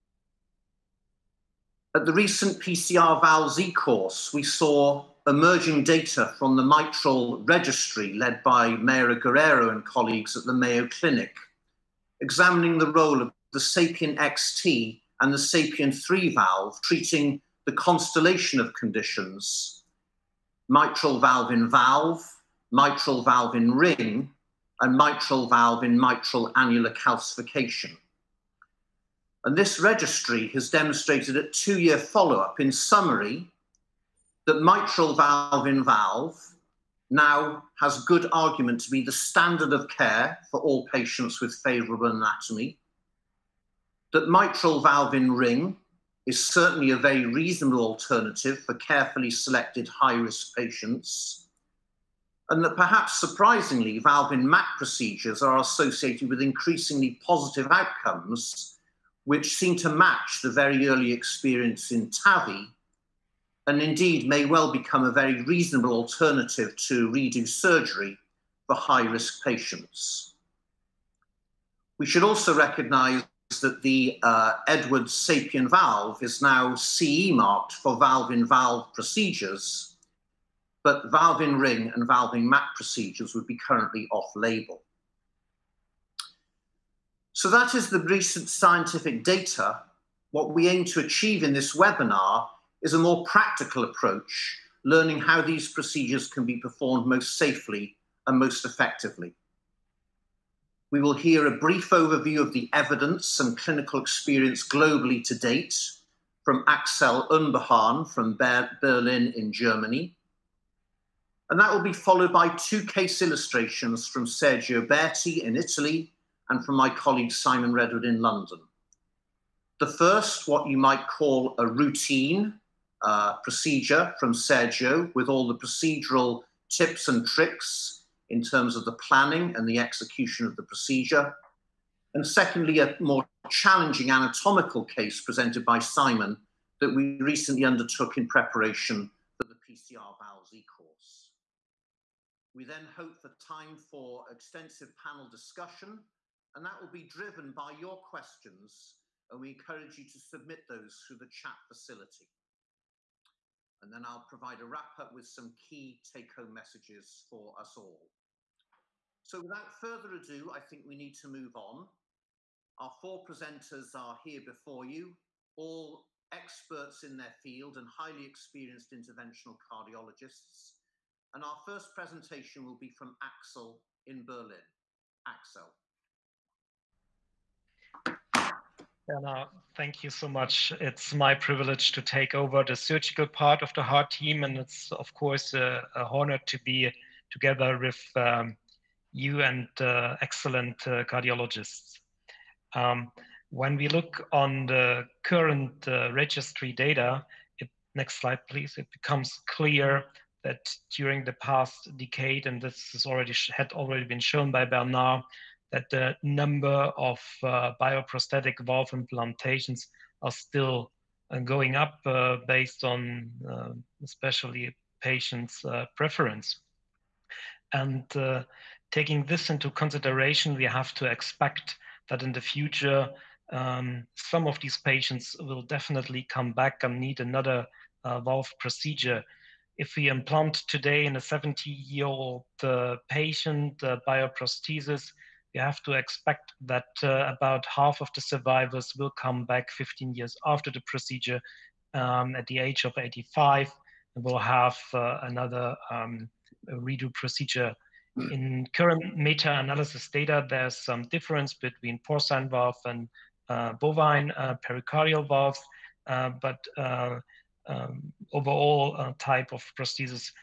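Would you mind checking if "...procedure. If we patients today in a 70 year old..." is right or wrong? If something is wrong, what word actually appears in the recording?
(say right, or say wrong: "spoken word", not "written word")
wrong: "implant", not "patients".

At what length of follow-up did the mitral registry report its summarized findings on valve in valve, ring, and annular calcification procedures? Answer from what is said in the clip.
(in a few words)
2 years.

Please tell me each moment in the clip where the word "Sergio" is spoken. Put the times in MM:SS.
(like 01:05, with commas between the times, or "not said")
01:54, 02:04.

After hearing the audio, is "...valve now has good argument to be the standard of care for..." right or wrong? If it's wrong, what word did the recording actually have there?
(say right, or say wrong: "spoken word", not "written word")
right.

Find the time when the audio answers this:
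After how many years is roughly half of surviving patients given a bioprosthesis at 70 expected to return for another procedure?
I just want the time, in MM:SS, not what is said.
03:59.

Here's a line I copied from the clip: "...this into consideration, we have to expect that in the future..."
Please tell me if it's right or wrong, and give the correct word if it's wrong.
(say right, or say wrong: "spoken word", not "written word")
right.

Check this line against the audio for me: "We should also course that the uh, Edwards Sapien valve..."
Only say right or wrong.
wrong.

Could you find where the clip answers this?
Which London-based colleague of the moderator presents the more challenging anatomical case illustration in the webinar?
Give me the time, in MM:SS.
01:57.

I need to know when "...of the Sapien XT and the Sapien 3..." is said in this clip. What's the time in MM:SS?
00:13.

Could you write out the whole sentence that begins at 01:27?
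So that is the recent scientific data.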